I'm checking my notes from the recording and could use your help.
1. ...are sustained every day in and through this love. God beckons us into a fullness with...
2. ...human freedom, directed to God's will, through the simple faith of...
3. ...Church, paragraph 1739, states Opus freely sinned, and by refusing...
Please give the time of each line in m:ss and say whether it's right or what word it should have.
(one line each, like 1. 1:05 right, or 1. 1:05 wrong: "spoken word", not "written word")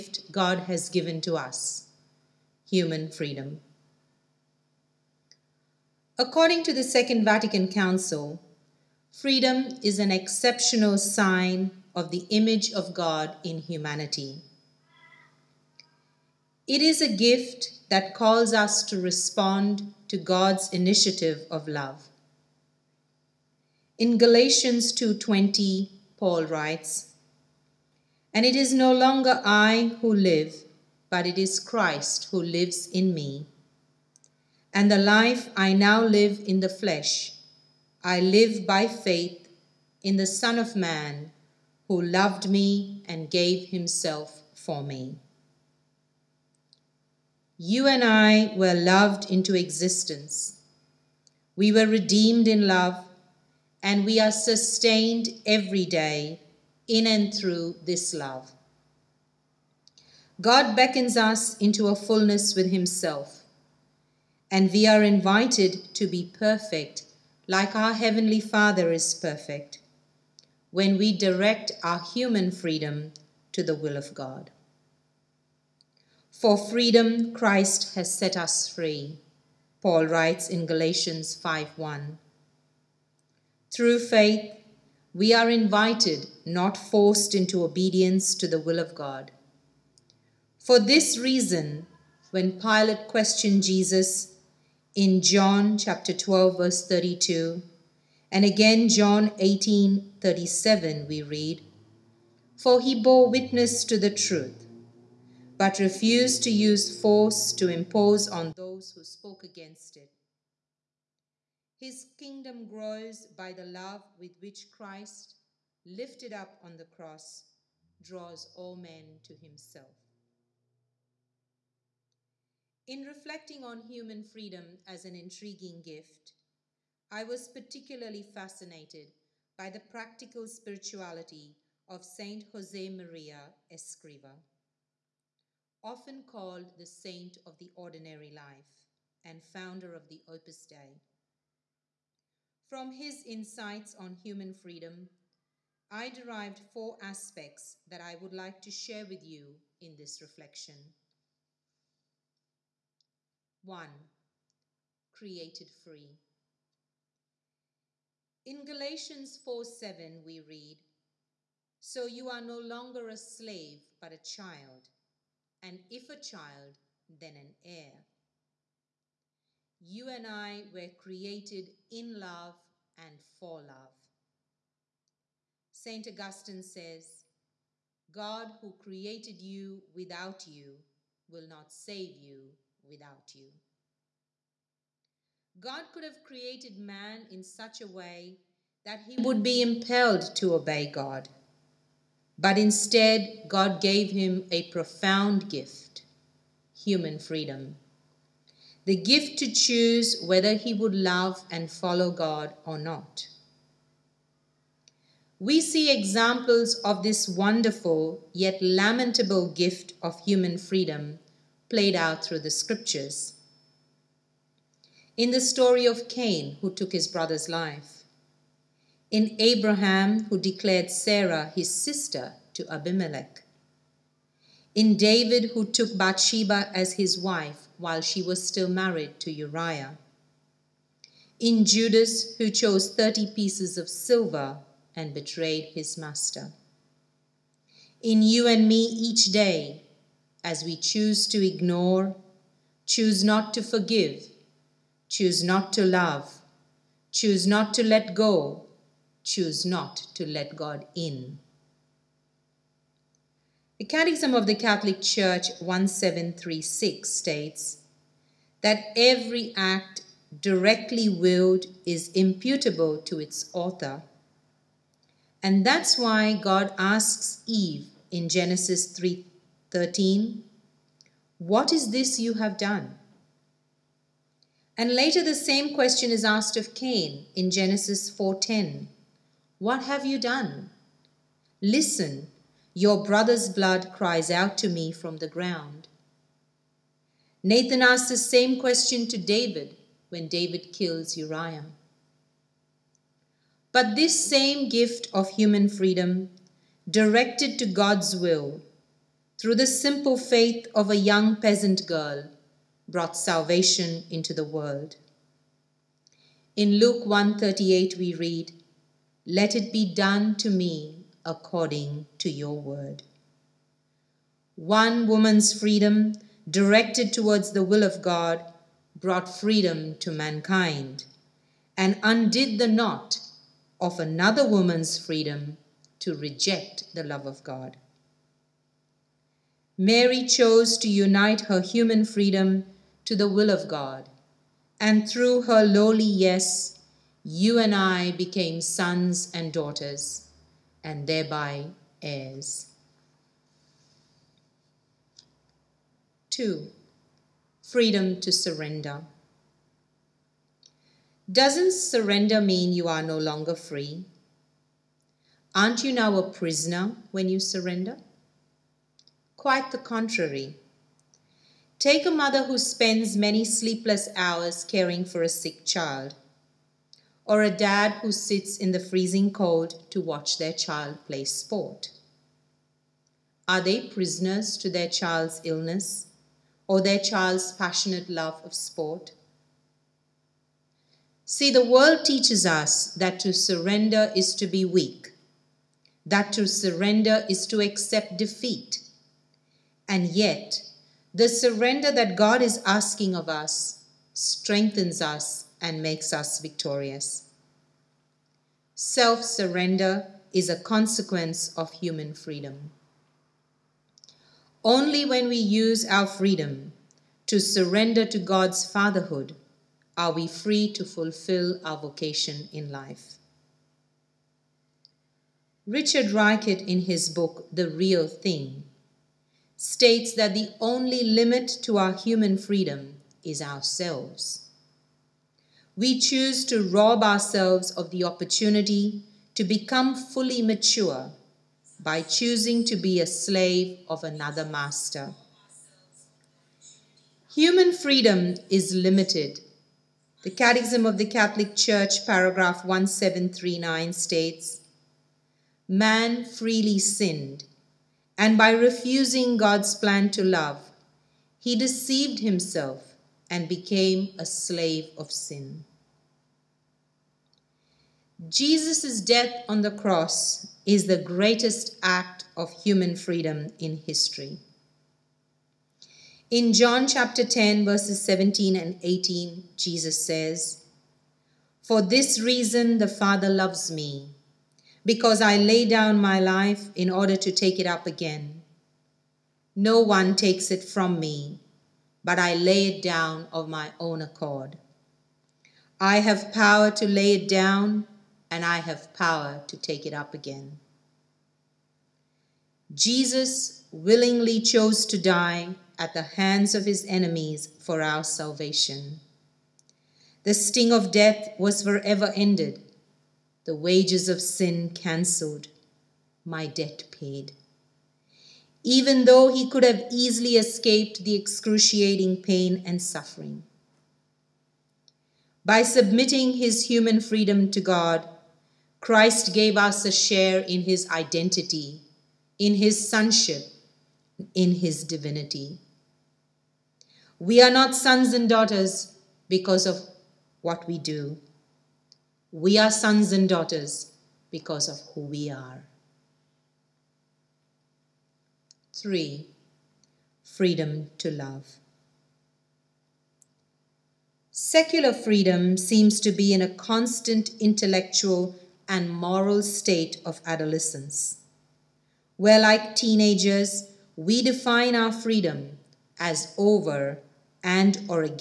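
1. 0:54 right
2. 4:55 right
3. 7:21 wrong: "Man", not "Opus".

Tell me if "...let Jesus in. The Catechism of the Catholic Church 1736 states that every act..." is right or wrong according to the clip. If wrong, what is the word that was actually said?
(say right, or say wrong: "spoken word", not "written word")
wrong: "God", not "Jesus".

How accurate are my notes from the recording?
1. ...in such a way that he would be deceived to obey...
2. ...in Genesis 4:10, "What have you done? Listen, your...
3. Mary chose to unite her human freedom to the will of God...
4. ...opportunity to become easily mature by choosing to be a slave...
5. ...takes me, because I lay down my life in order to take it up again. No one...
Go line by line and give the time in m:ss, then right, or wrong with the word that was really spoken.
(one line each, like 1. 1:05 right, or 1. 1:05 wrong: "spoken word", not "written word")
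1. 3:07 wrong: "impelled", not "deceived"
2. 4:37 right
3. 5:29 right
4. 7:08 wrong: "fully", not "easily"
5. 7:53 wrong: "loves", not "takes".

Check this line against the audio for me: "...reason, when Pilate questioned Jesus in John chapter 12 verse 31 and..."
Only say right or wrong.
wrong.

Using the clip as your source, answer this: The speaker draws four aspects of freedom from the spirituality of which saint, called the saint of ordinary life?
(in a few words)
Jose Maria Escriva.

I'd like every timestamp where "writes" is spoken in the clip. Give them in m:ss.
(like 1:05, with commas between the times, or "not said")
0:26, 1:20.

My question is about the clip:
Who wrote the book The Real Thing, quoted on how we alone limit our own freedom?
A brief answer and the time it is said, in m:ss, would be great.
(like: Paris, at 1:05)
Richard Reichert, at 6:55.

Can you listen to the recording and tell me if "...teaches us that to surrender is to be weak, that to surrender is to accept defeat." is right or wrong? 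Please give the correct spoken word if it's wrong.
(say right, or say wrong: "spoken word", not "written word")
right.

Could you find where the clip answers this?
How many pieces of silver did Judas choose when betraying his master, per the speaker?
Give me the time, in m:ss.
3:52.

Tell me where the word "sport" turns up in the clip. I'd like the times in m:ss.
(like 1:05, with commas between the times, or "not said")
6:11, 6:18.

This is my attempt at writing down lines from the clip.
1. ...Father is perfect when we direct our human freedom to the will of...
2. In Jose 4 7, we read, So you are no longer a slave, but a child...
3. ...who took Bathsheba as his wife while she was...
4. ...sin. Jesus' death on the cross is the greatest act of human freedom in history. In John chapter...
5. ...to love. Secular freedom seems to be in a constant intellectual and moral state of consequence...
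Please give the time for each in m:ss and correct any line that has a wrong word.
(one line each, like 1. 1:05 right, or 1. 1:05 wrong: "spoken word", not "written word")
1. 1:08 right
2. 2:38 wrong: "Galatians", not "Jose"
3. 3:45 right
4. 7:35 right
5. 9:00 wrong: "adolescence", not "consequence".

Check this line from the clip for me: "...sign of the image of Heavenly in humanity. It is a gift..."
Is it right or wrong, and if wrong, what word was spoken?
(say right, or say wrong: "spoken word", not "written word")
wrong: "God", not "Heavenly".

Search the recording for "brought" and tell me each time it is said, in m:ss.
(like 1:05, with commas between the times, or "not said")
5:02, 5:18.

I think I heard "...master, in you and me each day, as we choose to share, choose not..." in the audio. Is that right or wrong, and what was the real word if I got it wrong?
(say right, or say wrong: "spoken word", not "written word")
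wrong: "ignore", not "share".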